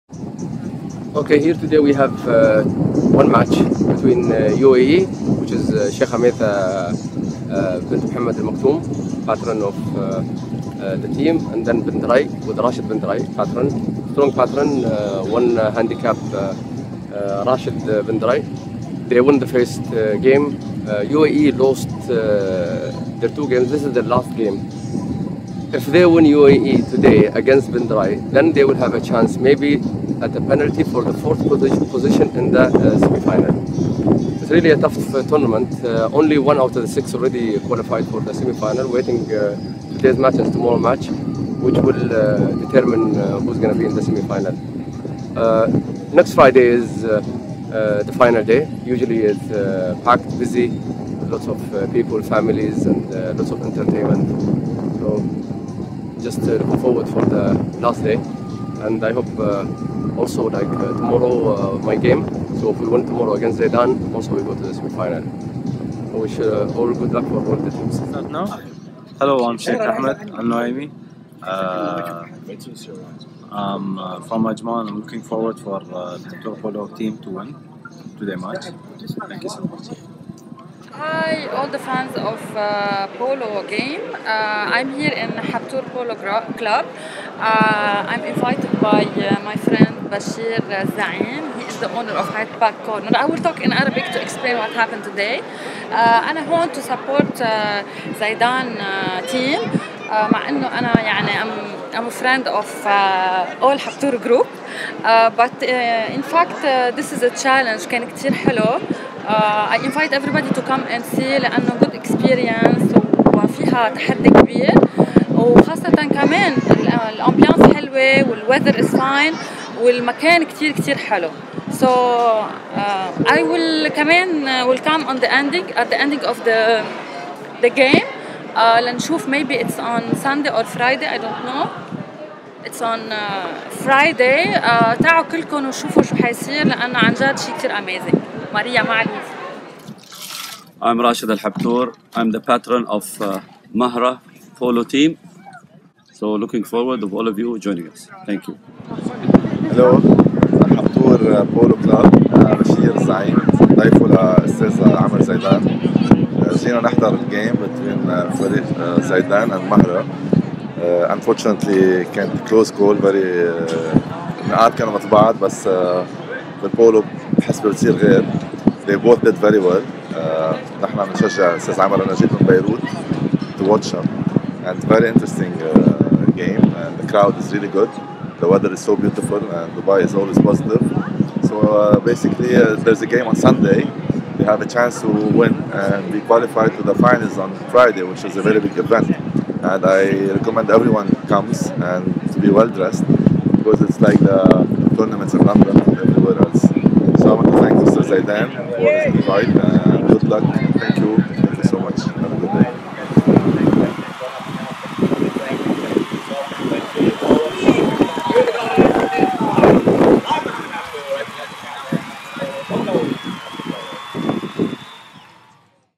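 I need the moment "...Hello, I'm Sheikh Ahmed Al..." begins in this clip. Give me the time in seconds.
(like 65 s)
69 s.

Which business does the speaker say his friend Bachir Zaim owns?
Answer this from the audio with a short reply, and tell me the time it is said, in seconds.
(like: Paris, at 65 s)
Hyde Park Corner, at 92 s.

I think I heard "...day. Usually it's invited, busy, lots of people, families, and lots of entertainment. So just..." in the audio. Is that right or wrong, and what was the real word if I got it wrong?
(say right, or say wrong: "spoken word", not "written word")
wrong: "packed", not "invited".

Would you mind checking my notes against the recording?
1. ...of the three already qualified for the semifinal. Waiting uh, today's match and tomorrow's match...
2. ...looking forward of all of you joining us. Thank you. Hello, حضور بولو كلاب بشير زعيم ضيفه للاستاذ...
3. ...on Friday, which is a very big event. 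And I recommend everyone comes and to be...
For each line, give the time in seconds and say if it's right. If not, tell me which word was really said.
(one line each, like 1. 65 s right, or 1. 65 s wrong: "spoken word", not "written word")
1. 36 s wrong: "six", not "three"
2. 146 s right
3. 187 s right.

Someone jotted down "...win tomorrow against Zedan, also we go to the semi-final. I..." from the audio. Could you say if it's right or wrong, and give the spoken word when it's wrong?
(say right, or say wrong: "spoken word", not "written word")
right.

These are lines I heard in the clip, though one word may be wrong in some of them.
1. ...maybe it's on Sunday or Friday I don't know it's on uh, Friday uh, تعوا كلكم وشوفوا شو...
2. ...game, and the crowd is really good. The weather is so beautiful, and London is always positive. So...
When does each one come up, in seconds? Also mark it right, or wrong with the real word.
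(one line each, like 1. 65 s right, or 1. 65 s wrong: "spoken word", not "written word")
1. 129 s right
2. 176 s wrong: "Dubai", not "London".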